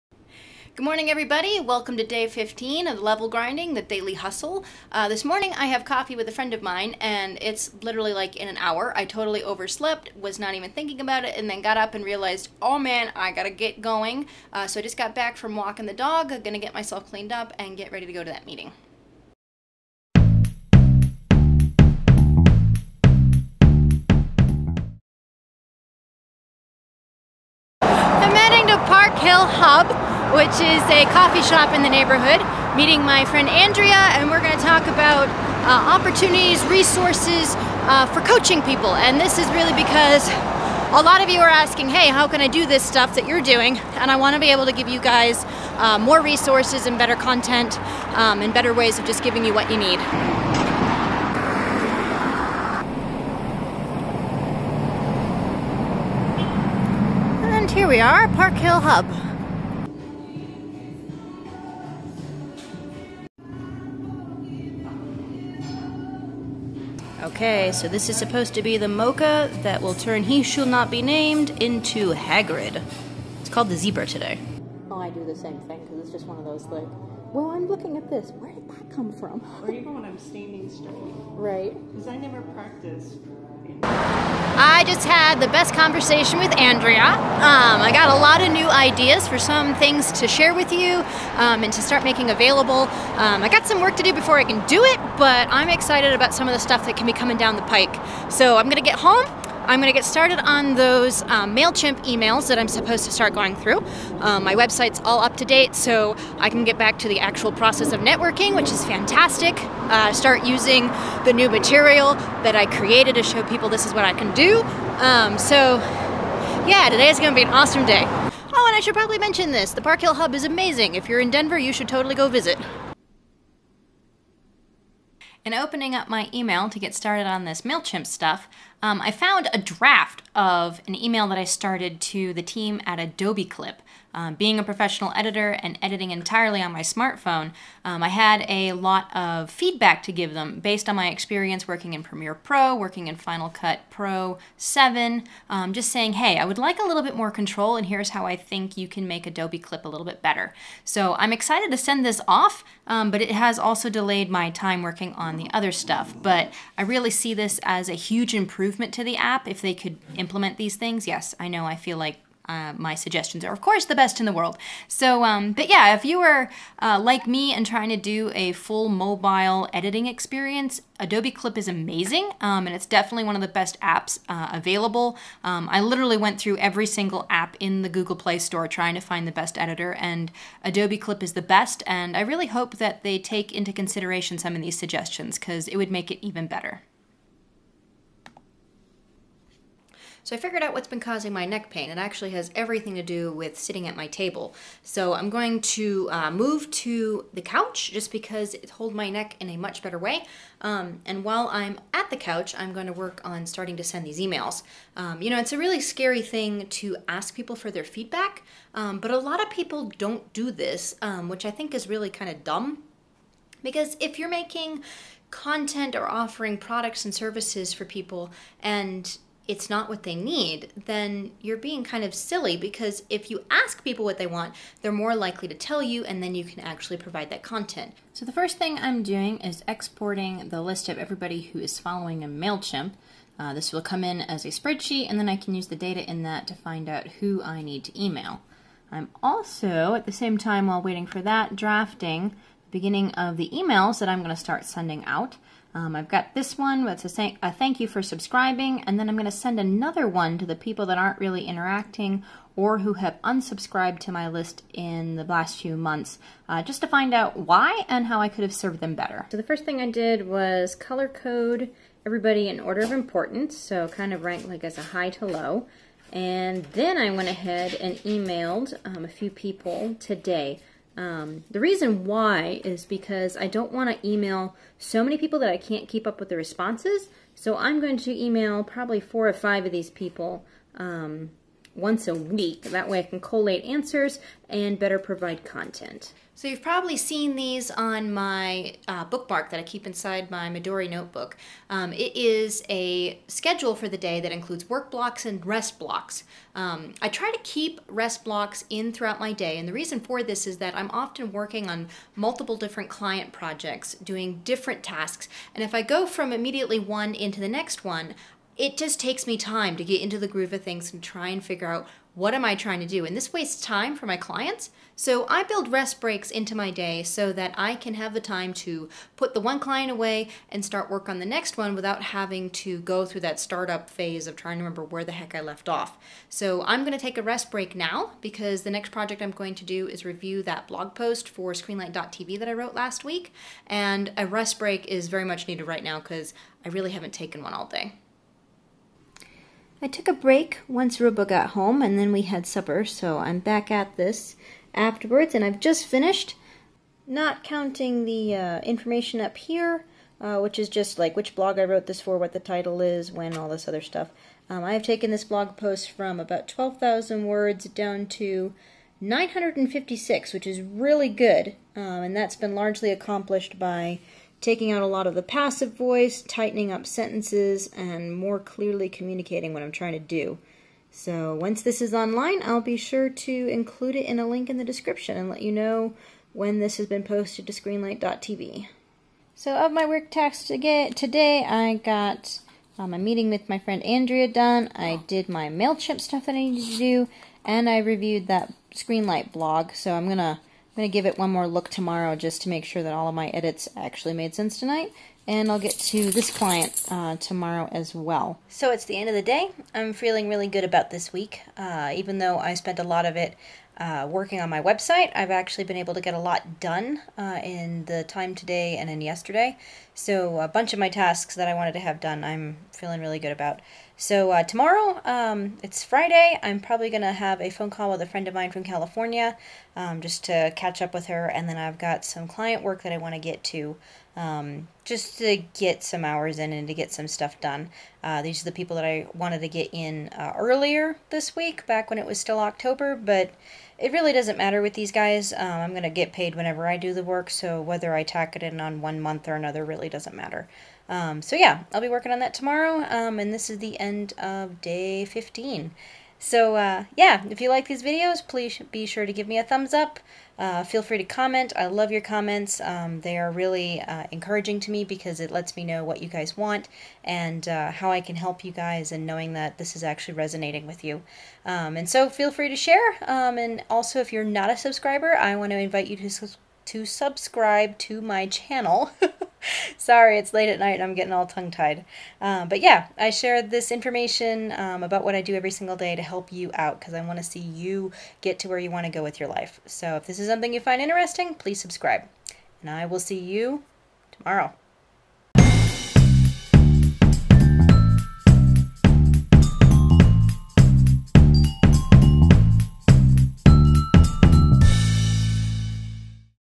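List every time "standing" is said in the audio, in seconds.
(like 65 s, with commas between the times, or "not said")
80 s.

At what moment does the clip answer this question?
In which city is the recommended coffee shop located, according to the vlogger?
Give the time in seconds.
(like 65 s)
121 s.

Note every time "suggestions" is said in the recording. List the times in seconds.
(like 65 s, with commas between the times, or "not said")
162 s, 184 s.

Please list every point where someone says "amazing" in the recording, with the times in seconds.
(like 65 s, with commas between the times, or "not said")
120 s, 171 s.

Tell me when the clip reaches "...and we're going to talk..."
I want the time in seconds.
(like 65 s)
34 s.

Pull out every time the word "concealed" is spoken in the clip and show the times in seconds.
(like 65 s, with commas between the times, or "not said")
not said.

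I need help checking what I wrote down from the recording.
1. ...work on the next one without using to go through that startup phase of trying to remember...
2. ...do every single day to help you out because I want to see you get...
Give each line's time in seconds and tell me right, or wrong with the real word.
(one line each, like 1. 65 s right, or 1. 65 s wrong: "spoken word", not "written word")
1. 320 s wrong: "having", not "using"
2. 475 s right.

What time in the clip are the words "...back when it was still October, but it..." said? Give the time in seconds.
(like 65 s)
431 s.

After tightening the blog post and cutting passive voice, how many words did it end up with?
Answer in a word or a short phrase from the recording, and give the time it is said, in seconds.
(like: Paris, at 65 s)
956, at 358 s.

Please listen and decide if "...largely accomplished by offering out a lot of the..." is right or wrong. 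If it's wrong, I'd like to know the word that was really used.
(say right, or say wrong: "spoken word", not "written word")
wrong: "taking", not "offering".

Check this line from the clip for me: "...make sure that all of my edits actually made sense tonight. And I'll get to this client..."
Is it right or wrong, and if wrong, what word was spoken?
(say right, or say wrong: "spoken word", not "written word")
right.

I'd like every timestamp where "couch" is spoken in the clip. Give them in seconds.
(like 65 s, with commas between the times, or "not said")
197 s, 202 s.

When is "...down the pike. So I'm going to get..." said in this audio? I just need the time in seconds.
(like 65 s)
97 s.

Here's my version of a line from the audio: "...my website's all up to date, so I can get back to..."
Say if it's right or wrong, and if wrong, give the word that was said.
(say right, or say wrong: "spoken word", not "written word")
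right.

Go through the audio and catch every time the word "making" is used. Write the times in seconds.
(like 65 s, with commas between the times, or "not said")
92 s, 214 s.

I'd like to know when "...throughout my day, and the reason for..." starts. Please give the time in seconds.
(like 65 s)
298 s.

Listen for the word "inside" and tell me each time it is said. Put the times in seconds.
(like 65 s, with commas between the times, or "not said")
289 s.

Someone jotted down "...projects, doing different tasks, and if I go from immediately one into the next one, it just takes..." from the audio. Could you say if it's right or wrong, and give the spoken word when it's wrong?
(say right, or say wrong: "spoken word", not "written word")
right.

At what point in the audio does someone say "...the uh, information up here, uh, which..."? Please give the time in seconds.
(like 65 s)
348 s.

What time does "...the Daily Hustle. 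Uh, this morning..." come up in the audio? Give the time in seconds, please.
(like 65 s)
3 s.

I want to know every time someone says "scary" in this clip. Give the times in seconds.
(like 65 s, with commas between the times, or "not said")
205 s.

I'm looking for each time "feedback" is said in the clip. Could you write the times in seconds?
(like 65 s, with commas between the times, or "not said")
139 s, 207 s.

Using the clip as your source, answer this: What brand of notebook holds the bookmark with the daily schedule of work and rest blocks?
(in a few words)
Midori.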